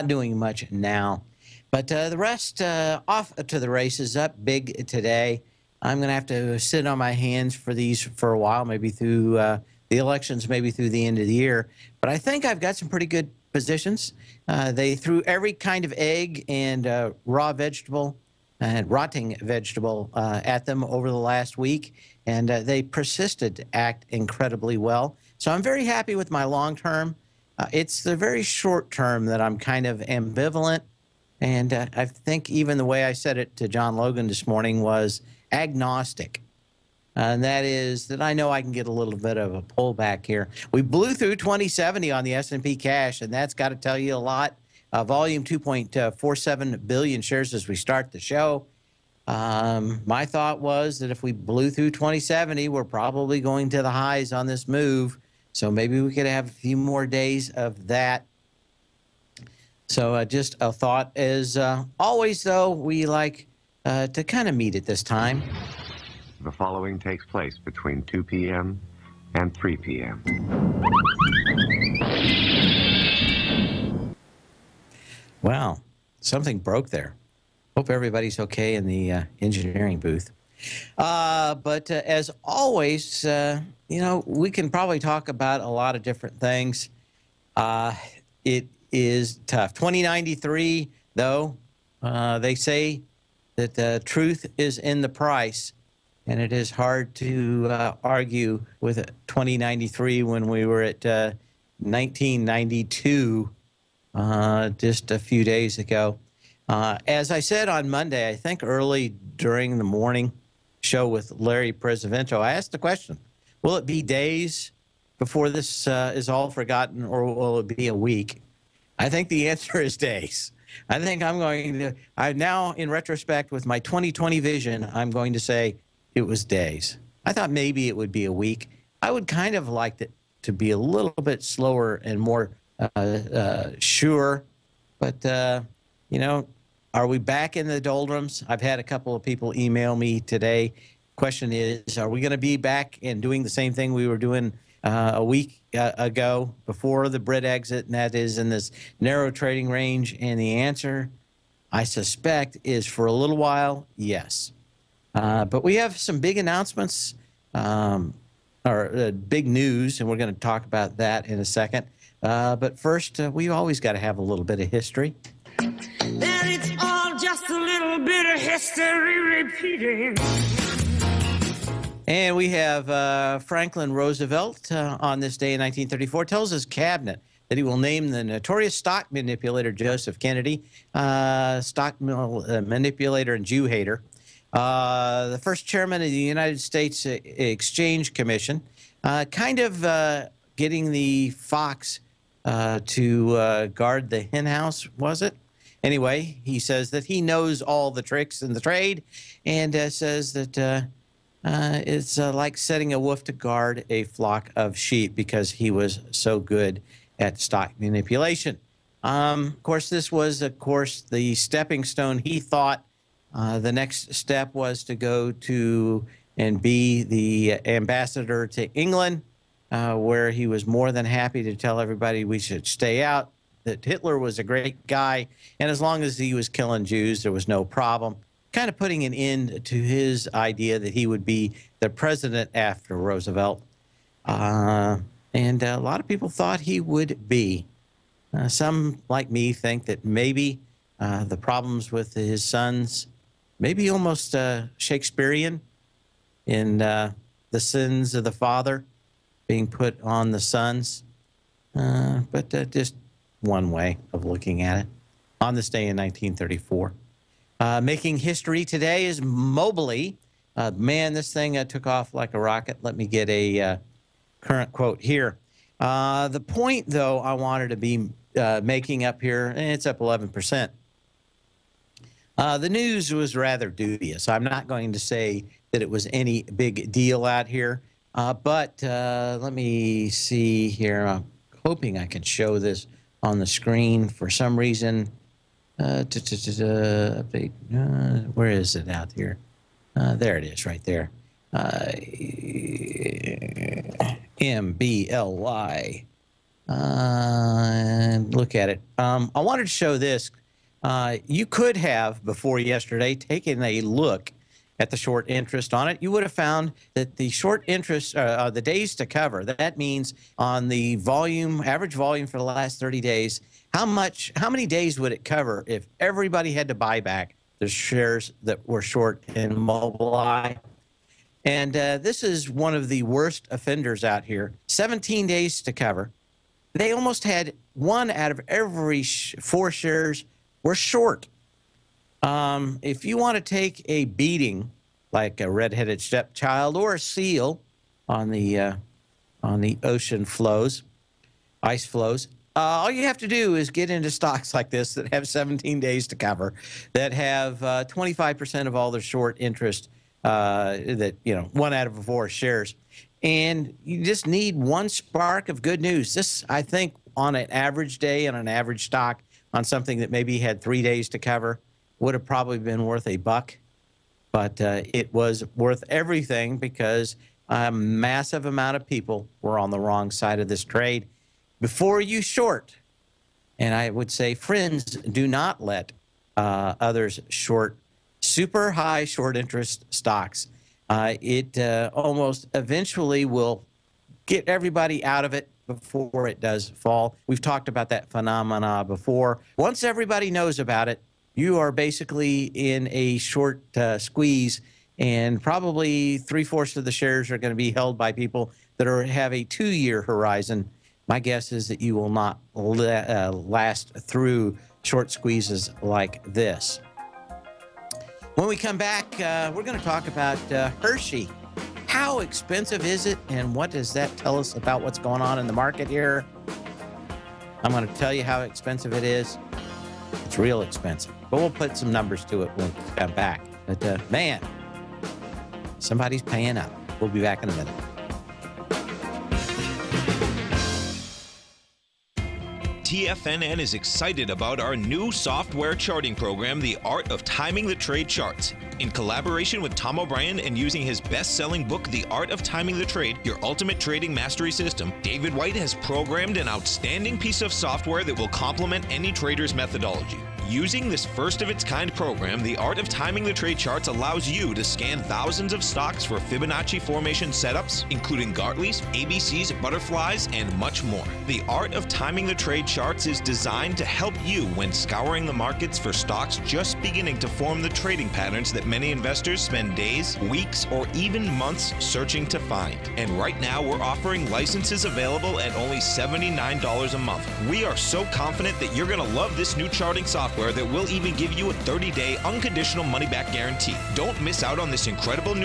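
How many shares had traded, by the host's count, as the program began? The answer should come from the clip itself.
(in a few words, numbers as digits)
2.47 billion.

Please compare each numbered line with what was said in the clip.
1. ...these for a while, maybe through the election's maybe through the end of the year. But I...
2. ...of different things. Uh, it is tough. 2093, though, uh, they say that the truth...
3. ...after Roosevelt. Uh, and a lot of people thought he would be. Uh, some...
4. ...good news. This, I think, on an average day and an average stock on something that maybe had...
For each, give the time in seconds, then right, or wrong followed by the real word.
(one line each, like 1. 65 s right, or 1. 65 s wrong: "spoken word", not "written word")
1. 7 s right
2. 85 s right
3. 232 s right
4. 355 s right.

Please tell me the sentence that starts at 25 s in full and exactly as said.
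So I'm very happy with my long term.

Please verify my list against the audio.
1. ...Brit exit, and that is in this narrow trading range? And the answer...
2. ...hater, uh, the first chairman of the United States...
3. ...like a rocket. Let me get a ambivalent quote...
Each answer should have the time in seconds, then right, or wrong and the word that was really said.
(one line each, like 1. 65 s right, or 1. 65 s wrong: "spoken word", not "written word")
1. 147 s right
2. 183 s right
3. 262 s wrong: "current", not "ambivalent".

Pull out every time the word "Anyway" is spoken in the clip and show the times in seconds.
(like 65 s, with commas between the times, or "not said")
195 s.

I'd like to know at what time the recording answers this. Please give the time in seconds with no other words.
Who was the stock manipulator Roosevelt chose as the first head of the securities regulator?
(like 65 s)
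179 s.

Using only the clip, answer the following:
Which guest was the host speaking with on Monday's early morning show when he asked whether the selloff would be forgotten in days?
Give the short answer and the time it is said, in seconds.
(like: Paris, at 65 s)
Larry Pesavento, at 111 s.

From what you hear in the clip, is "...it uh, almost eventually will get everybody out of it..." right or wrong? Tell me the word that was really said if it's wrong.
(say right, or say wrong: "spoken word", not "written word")
right.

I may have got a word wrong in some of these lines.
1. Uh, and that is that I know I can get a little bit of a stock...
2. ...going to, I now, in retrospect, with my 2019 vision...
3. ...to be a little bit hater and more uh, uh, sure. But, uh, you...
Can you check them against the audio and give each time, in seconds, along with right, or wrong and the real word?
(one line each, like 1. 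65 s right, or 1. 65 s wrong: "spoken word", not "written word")
1. 37 s wrong: "pullback", not "stock"
2. 121 s wrong: "2020", not "2019"
3. 130 s wrong: "slower", not "hater".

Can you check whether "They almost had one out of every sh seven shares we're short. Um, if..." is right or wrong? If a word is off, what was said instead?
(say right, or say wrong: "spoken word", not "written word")
wrong: "four", not "seven".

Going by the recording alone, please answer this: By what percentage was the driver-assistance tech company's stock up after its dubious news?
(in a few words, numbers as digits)
11%.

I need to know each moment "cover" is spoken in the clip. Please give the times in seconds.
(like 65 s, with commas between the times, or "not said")
309 s, 315 s, 325 s, 346 s, 361 s.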